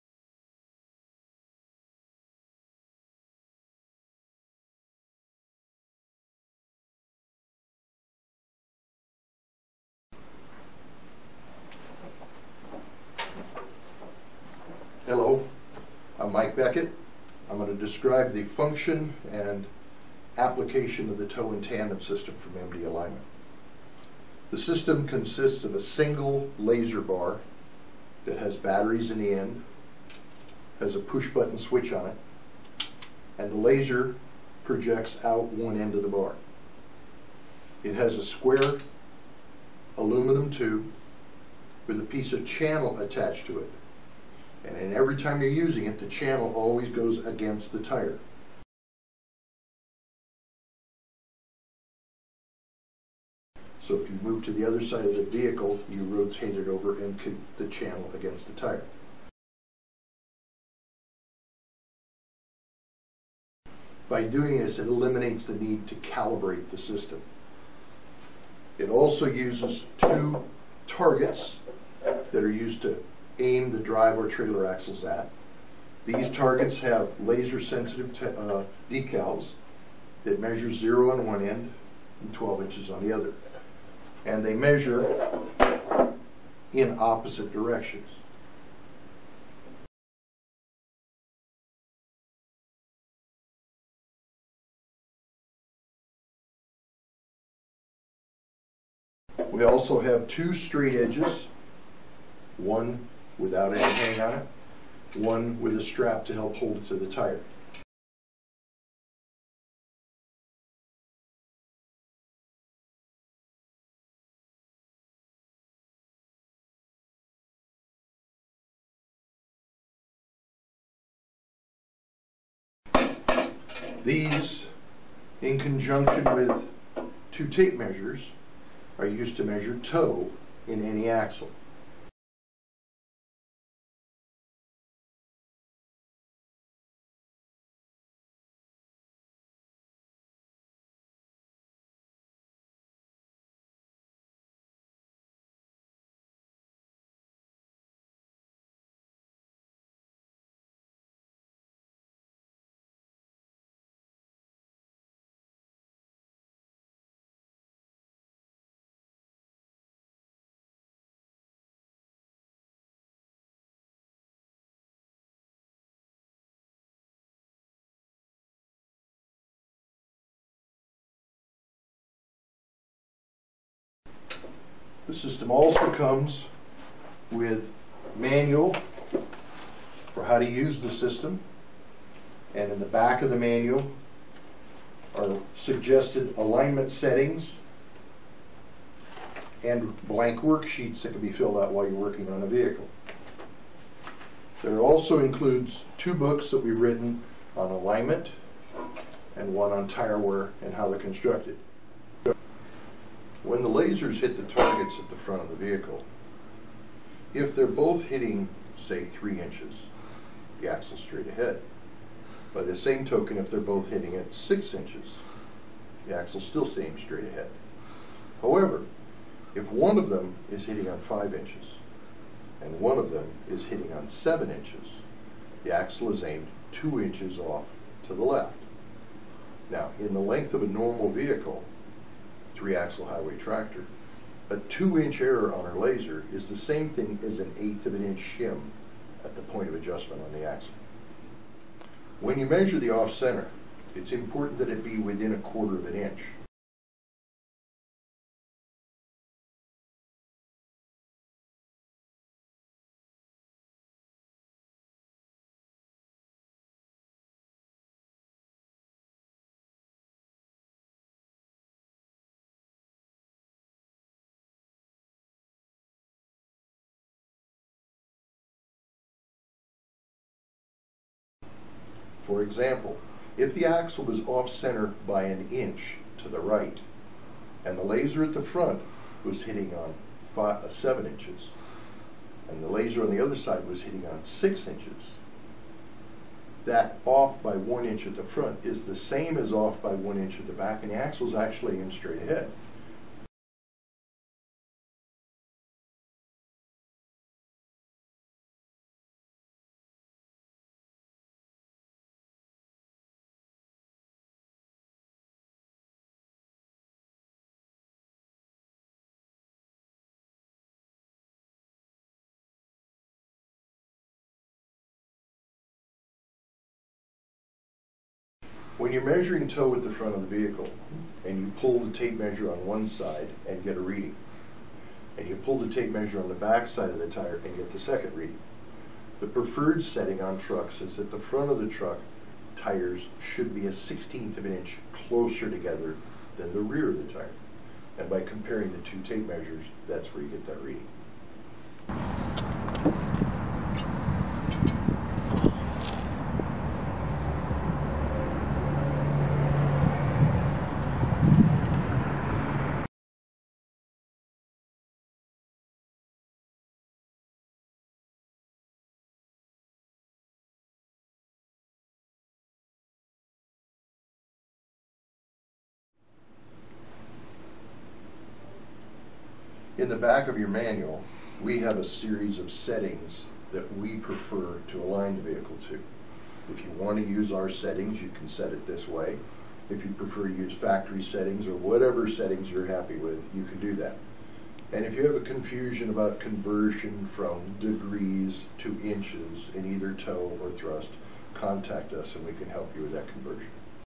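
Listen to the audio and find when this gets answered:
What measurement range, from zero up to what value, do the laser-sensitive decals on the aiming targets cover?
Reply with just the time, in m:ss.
1:22.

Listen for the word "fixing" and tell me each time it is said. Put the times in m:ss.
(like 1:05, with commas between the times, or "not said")
not said.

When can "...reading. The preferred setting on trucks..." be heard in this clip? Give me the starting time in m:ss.
5:28.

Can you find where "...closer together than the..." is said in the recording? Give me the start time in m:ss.
5:34.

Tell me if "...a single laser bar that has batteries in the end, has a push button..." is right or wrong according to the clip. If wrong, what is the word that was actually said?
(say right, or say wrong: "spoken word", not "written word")
right.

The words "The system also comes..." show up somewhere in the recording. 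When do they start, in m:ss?
2:55.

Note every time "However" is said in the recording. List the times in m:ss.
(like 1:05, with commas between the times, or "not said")
3:38.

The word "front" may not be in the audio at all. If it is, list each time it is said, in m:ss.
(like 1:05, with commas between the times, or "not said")
3:25, 4:38, 4:48, 5:19, 5:31.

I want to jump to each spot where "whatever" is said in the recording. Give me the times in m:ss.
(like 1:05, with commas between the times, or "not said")
6:21.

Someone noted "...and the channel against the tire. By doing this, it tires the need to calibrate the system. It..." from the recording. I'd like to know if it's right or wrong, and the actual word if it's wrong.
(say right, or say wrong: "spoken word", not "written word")
wrong: "eliminates", not "tires".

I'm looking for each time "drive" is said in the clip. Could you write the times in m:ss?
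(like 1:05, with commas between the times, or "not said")
1:13.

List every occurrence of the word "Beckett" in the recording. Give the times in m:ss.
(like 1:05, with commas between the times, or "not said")
0:16.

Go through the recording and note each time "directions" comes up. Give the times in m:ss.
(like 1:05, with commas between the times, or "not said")
1:27.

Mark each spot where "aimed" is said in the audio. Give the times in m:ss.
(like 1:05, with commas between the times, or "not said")
3:46, 4:51.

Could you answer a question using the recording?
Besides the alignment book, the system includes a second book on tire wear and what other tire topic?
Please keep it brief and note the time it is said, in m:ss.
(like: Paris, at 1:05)
how they're constructed, at 3:20.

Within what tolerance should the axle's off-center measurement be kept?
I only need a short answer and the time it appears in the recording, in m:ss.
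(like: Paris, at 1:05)
1/4 inch, at 4:05.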